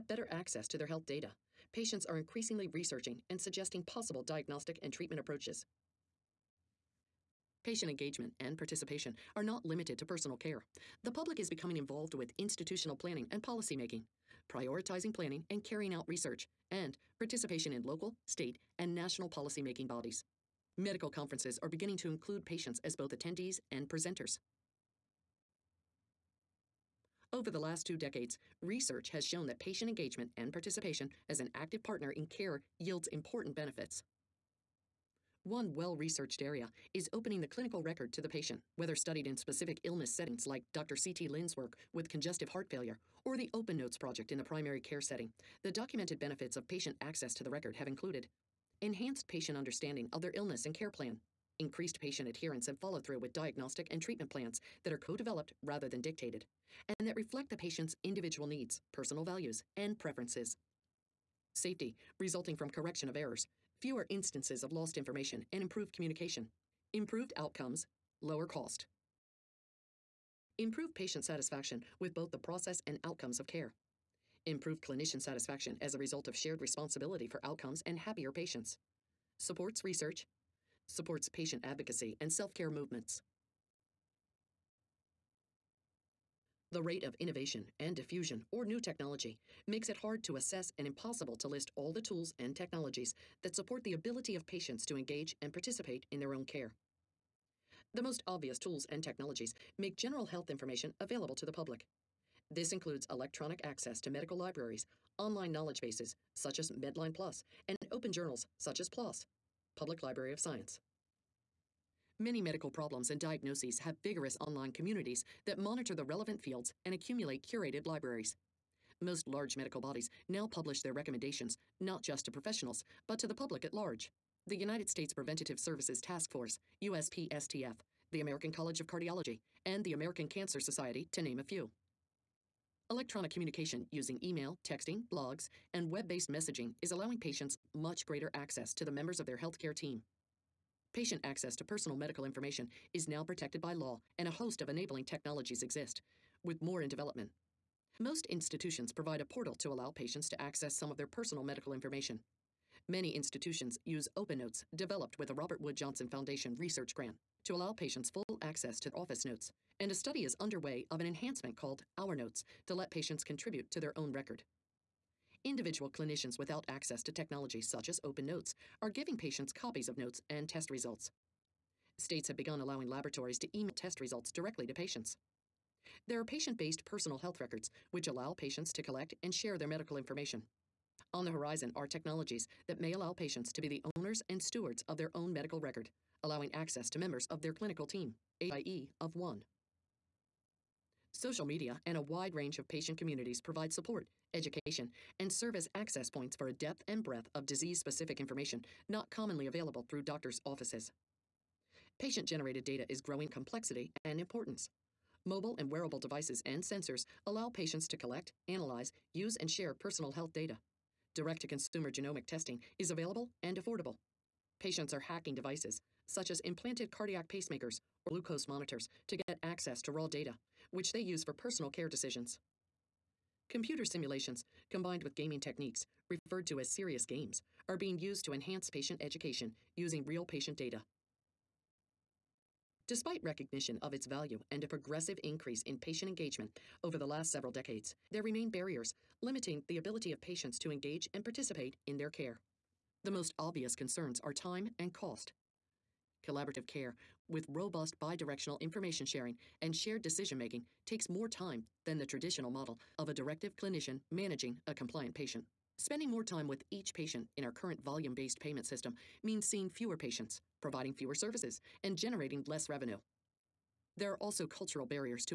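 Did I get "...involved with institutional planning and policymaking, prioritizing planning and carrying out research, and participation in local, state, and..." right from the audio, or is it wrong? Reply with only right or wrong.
right.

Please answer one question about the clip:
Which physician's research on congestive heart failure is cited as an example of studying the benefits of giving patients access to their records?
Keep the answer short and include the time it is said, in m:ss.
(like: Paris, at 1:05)
Dr. C.T. Lin, at 0:40.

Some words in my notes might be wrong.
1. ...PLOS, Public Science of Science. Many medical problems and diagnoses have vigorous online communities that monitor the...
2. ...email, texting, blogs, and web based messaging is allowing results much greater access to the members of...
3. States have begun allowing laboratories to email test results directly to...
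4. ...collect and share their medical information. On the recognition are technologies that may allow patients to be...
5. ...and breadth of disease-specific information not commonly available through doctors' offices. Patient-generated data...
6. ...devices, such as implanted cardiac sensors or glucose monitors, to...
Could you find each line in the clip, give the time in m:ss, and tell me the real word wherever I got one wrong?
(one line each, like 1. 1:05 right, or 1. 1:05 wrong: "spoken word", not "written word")
1. 1:48 wrong: "Library", not "Science"
2. 2:14 wrong: "patients", not "results"
3. 2:51 right
4. 2:58 wrong: "horizon", not "recognition"
5. 3:16 right
6. 3:35 wrong: "pacemakers", not "sensors".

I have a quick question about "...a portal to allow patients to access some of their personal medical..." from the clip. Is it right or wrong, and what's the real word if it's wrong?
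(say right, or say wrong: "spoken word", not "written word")
right.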